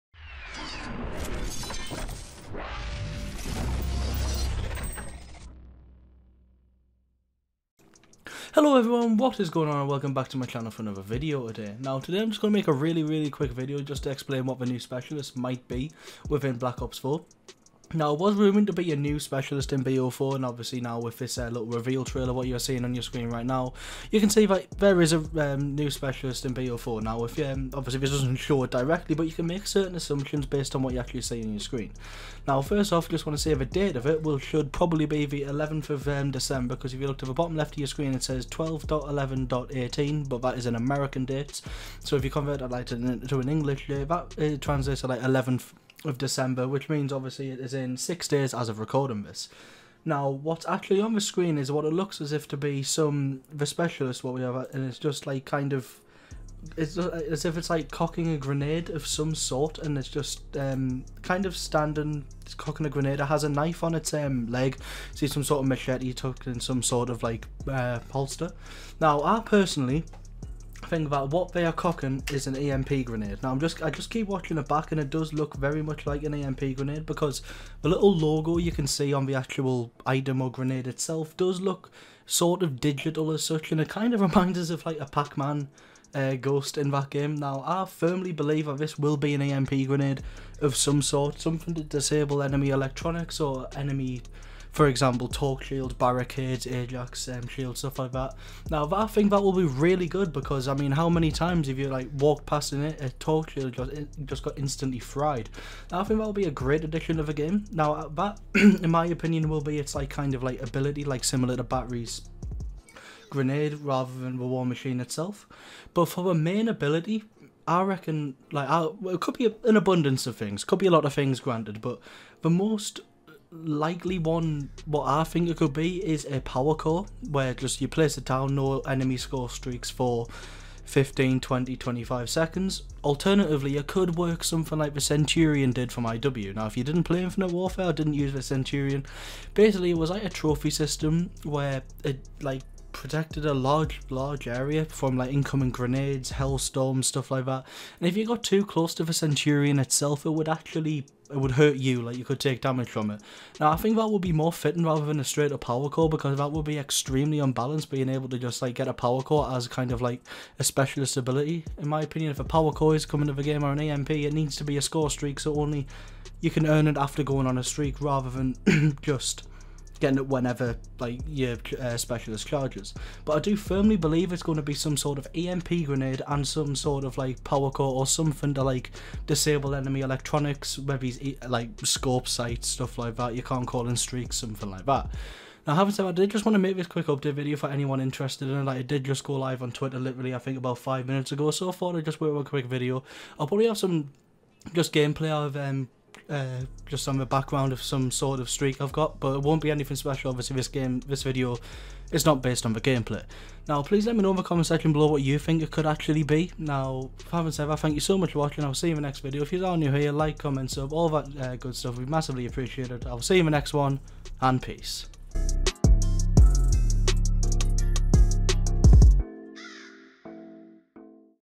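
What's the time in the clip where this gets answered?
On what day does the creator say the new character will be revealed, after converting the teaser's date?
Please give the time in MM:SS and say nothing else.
00:45.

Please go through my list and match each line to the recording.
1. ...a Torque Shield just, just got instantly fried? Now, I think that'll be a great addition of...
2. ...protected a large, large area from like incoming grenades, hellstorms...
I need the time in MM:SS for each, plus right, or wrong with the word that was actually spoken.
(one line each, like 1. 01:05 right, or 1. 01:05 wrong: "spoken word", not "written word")
1. 01:42 right
2. 02:22 right.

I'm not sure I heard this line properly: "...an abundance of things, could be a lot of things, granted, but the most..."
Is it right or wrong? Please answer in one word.
right.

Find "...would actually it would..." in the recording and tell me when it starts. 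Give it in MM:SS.
02:30.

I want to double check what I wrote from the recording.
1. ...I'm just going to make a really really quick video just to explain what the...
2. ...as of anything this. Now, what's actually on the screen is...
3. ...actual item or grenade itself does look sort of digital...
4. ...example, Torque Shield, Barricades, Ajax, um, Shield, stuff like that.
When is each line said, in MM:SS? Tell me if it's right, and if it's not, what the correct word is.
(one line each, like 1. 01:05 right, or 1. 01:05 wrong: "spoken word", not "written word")
1. 00:12 right
2. 00:48 wrong: "recording", not "anything"
3. 01:19 right
4. 01:34 right.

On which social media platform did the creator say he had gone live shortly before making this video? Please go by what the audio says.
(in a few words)
Twitter.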